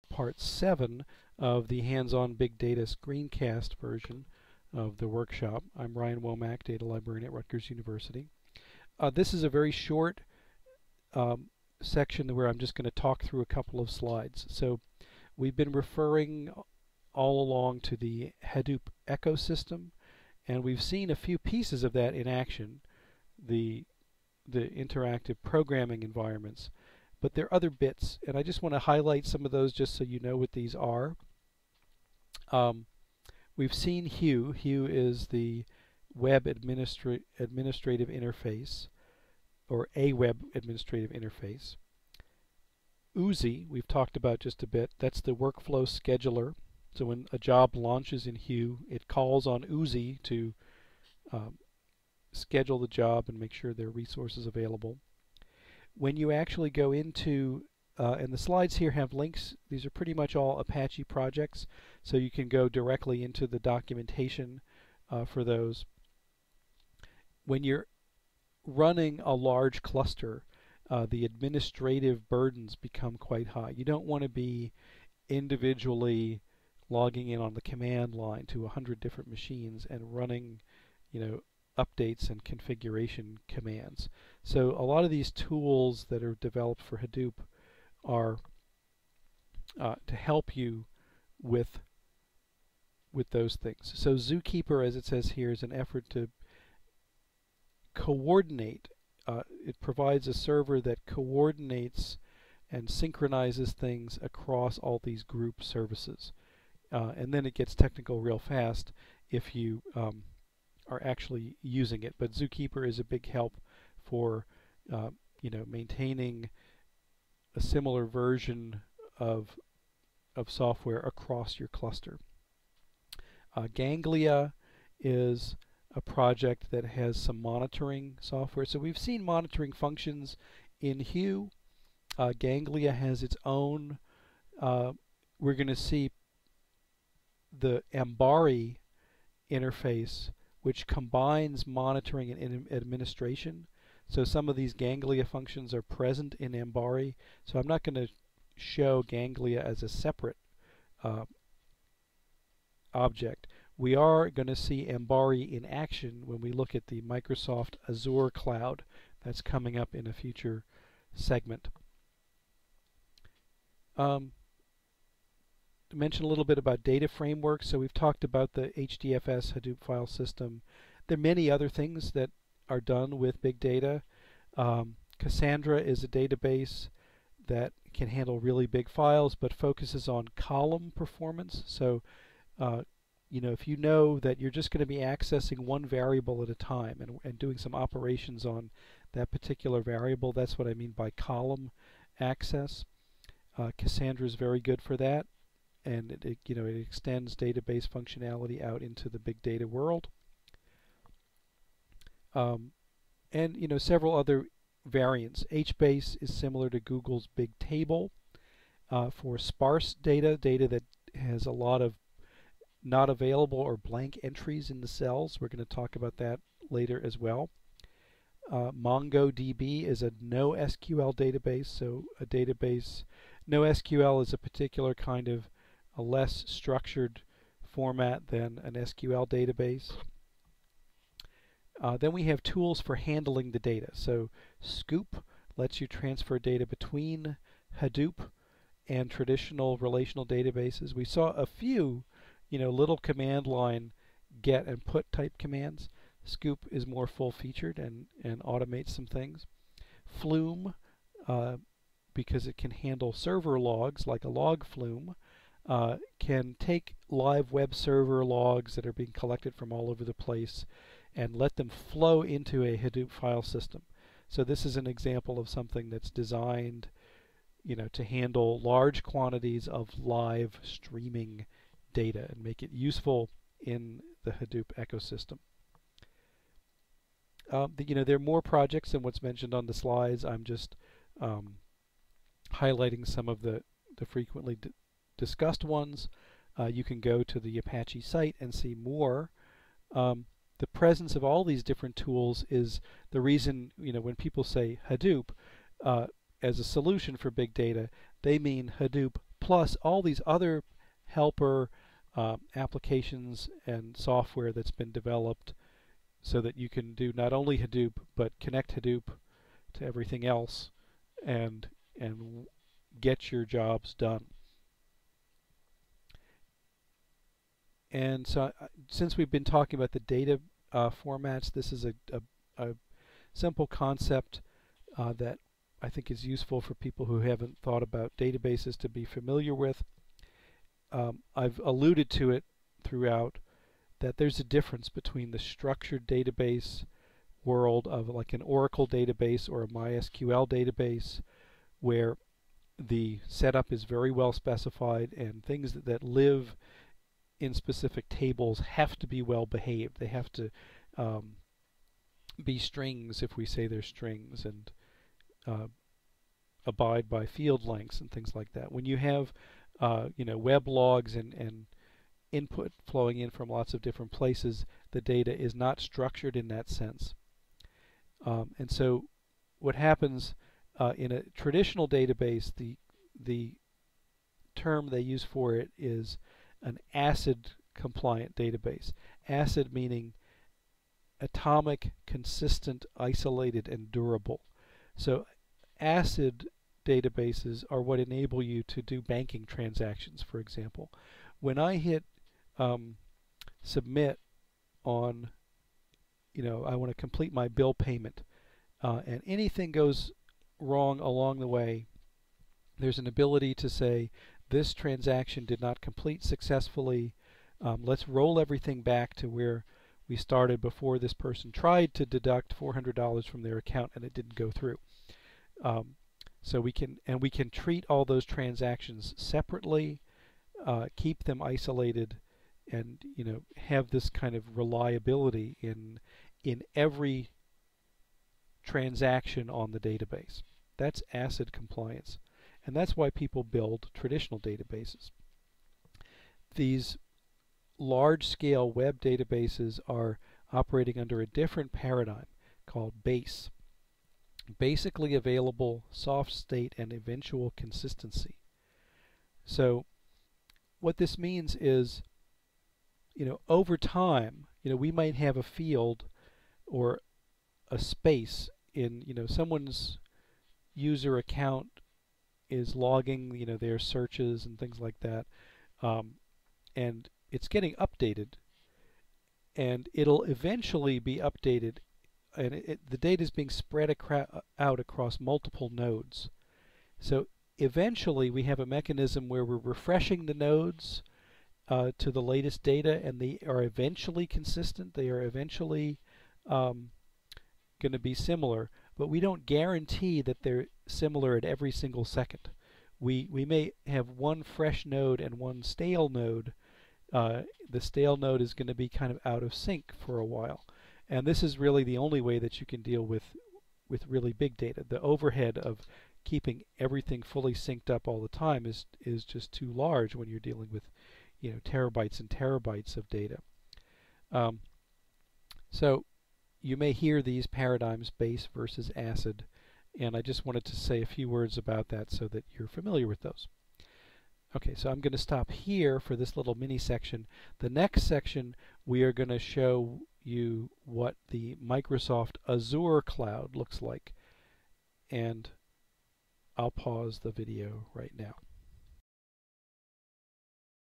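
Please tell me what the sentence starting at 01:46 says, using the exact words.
Uh, and then it gets technical real fast if you um, are actually using it.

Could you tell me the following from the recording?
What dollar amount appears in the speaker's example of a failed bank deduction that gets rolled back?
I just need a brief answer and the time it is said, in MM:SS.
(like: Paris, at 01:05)
$400, at 06:52.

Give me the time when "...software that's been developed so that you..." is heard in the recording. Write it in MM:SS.
05:03.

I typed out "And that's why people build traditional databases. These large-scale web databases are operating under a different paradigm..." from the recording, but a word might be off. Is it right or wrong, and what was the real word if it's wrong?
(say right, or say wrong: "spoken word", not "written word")
right.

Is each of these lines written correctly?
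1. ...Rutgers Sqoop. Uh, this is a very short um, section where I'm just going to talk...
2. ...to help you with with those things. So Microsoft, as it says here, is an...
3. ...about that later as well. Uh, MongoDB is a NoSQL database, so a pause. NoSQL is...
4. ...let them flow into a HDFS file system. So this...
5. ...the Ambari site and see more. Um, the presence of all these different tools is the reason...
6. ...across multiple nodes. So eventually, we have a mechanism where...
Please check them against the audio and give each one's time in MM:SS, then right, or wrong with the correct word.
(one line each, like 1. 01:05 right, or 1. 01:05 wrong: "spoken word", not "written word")
1. 00:07 wrong: "University", not "Sqoop"
2. 01:30 wrong: "Zookeeper", not "Microsoft"
3. 03:35 wrong: "database", not "pause"
4. 04:21 wrong: "Hadoop", not "HDFS"
5. 04:47 wrong: "Apache", not "Ambari"
6. 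07:54 right.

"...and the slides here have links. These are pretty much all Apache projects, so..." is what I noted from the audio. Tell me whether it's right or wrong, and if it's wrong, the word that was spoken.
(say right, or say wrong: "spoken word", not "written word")
right.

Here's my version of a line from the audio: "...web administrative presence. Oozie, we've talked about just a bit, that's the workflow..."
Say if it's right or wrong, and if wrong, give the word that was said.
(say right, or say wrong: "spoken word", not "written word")
wrong: "interface", not "presence".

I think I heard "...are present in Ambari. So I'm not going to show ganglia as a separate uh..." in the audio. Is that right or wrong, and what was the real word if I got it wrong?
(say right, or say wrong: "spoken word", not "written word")
right.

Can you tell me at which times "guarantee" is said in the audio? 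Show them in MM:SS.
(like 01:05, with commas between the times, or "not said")
08:09.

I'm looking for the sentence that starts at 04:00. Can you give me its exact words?
We saw a few, you know, little command line get and put type commands.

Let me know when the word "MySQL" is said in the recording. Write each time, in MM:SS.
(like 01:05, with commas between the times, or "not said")
05:39.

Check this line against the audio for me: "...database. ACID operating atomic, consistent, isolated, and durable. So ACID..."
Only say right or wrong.
wrong.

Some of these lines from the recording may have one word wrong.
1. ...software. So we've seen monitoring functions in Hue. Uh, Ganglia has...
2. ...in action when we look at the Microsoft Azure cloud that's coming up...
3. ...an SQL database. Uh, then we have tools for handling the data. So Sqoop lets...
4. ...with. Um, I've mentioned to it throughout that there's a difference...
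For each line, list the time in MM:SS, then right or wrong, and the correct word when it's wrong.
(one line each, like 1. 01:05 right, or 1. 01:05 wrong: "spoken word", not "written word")
1. 02:08 right
2. 02:35 right
3. 03:48 right
4. 05:29 wrong: "alluded", not "mentioned".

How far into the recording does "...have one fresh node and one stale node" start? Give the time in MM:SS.
08:13.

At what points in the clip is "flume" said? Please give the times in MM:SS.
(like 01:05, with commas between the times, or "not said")
04:10, 04:14.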